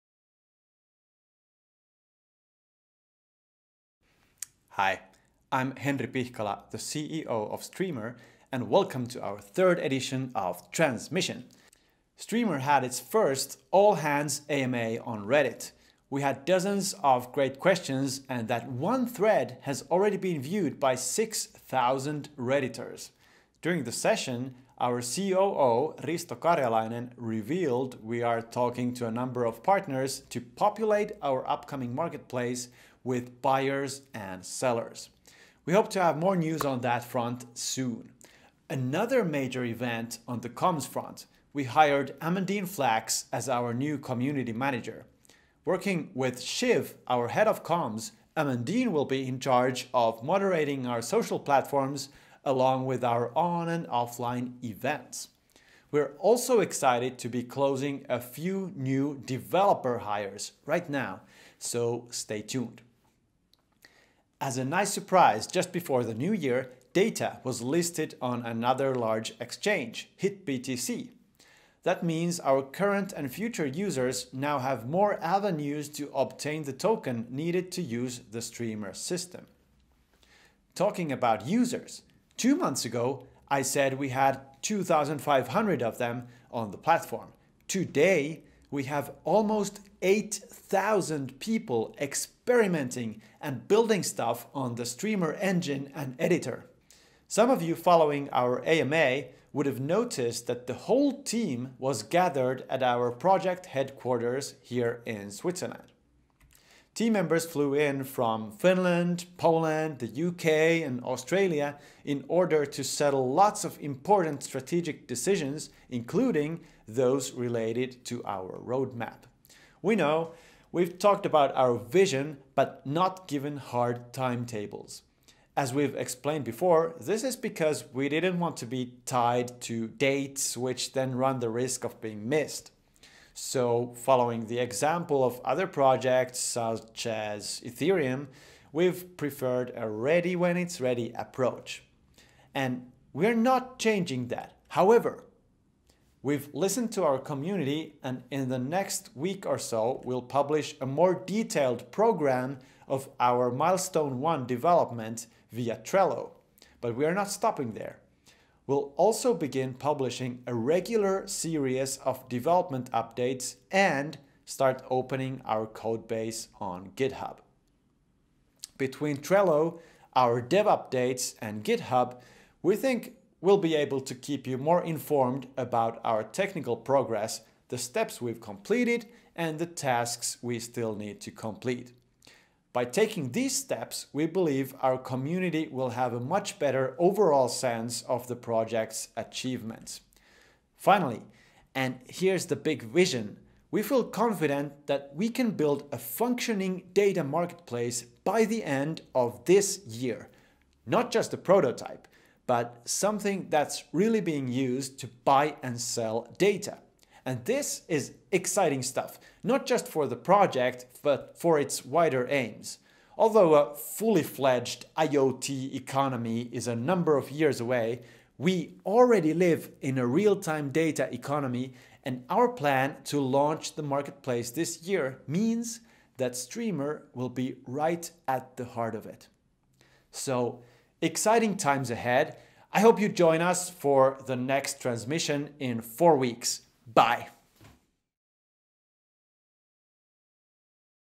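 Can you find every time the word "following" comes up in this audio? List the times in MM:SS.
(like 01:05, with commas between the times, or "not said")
01:37, 02:13.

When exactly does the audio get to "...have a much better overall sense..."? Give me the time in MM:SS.
03:05.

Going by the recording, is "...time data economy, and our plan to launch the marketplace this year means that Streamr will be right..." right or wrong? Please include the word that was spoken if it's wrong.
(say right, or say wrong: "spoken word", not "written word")
right.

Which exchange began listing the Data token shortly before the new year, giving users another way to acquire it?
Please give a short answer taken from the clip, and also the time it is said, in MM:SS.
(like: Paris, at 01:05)
HitBTC, at 01:10.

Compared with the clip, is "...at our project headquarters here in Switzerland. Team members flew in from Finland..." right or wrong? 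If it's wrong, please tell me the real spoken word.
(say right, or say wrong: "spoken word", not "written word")
right.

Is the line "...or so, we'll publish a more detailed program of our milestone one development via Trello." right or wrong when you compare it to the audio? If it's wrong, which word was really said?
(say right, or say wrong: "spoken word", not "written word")
right.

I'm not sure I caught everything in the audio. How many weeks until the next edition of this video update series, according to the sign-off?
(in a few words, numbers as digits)
4.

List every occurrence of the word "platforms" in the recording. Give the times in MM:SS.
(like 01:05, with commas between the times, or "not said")
00:51, 01:26.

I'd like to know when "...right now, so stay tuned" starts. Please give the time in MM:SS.
01:00.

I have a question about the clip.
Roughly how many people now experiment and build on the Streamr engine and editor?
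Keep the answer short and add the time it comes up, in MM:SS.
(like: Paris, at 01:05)
8,000, at 01:30.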